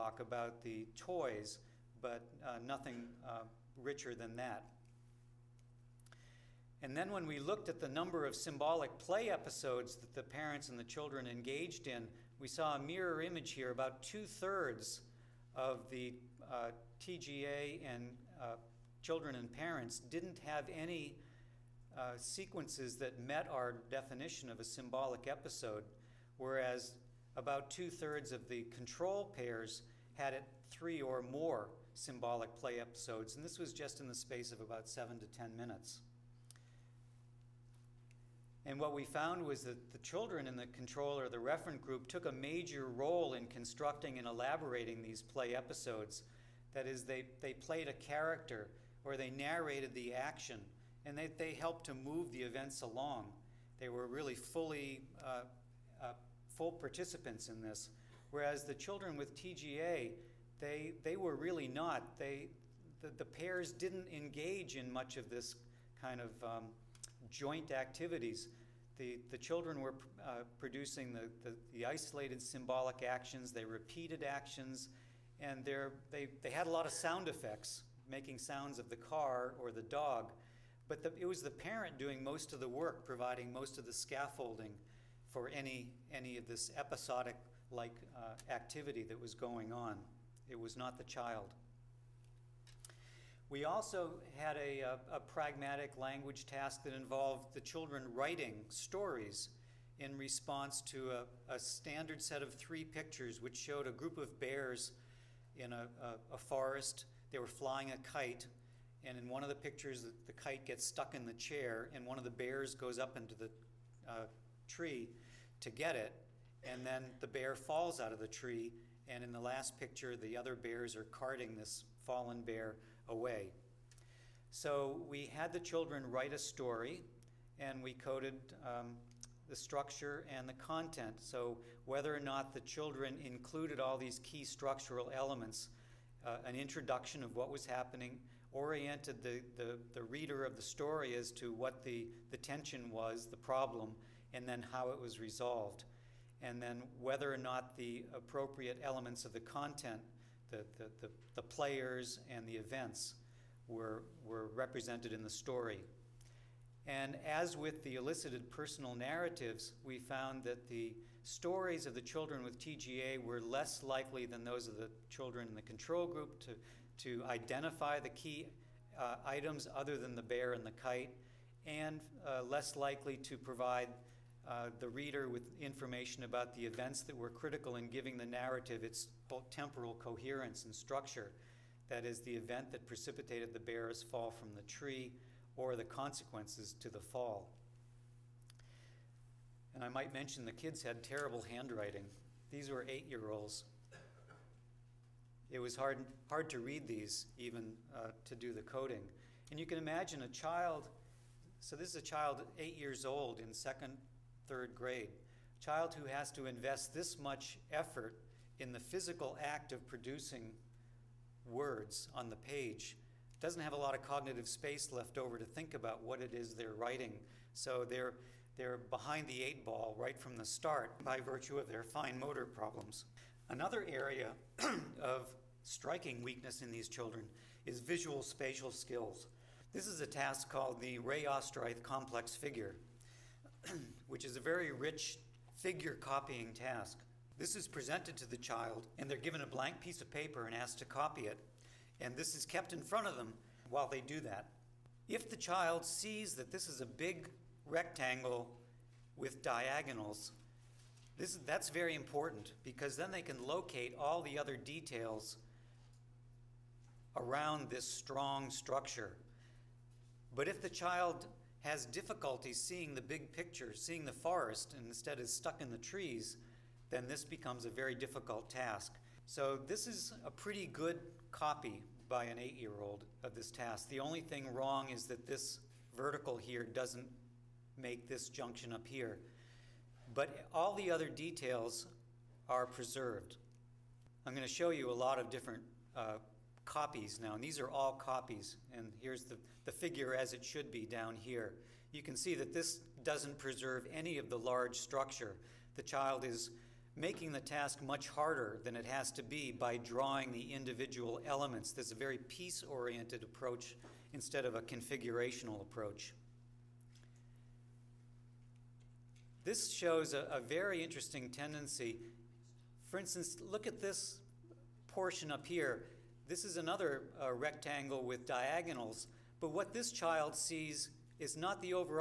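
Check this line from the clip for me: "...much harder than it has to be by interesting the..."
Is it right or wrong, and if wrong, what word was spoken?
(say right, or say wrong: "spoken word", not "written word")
wrong: "drawing", not "interesting".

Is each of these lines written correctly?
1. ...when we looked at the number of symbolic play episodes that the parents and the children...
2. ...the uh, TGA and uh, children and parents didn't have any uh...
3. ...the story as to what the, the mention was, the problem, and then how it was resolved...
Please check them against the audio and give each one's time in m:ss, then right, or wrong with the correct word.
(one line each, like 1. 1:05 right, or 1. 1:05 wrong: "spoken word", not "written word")
1. 0:07 right
2. 0:15 right
3. 2:20 wrong: "tension", not "mention".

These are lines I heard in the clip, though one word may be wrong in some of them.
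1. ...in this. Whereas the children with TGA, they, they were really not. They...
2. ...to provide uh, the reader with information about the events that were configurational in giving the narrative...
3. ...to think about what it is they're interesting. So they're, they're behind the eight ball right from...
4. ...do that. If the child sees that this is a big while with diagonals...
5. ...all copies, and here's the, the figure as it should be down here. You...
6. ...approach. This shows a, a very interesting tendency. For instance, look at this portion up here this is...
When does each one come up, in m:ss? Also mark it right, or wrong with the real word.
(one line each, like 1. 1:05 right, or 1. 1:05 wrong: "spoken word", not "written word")
1. 0:57 right
2. 2:53 wrong: "critical", not "configurational"
3. 3:35 wrong: "writing", not "interesting"
4. 4:04 wrong: "rectangle", not "while"
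5. 4:47 right
6. 5:05 right.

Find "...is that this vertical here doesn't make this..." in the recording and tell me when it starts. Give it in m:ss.
4:34.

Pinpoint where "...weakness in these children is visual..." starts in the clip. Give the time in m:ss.
3:46.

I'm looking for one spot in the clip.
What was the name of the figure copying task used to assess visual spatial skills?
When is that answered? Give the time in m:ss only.
3:50.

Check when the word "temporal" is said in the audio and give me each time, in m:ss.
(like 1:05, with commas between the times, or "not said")
2:59.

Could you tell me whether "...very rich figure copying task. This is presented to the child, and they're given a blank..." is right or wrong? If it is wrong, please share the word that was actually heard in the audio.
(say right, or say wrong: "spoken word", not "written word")
right.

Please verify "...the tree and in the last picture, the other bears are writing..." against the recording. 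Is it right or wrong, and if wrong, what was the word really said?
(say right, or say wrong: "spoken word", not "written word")
wrong: "carting", not "writing".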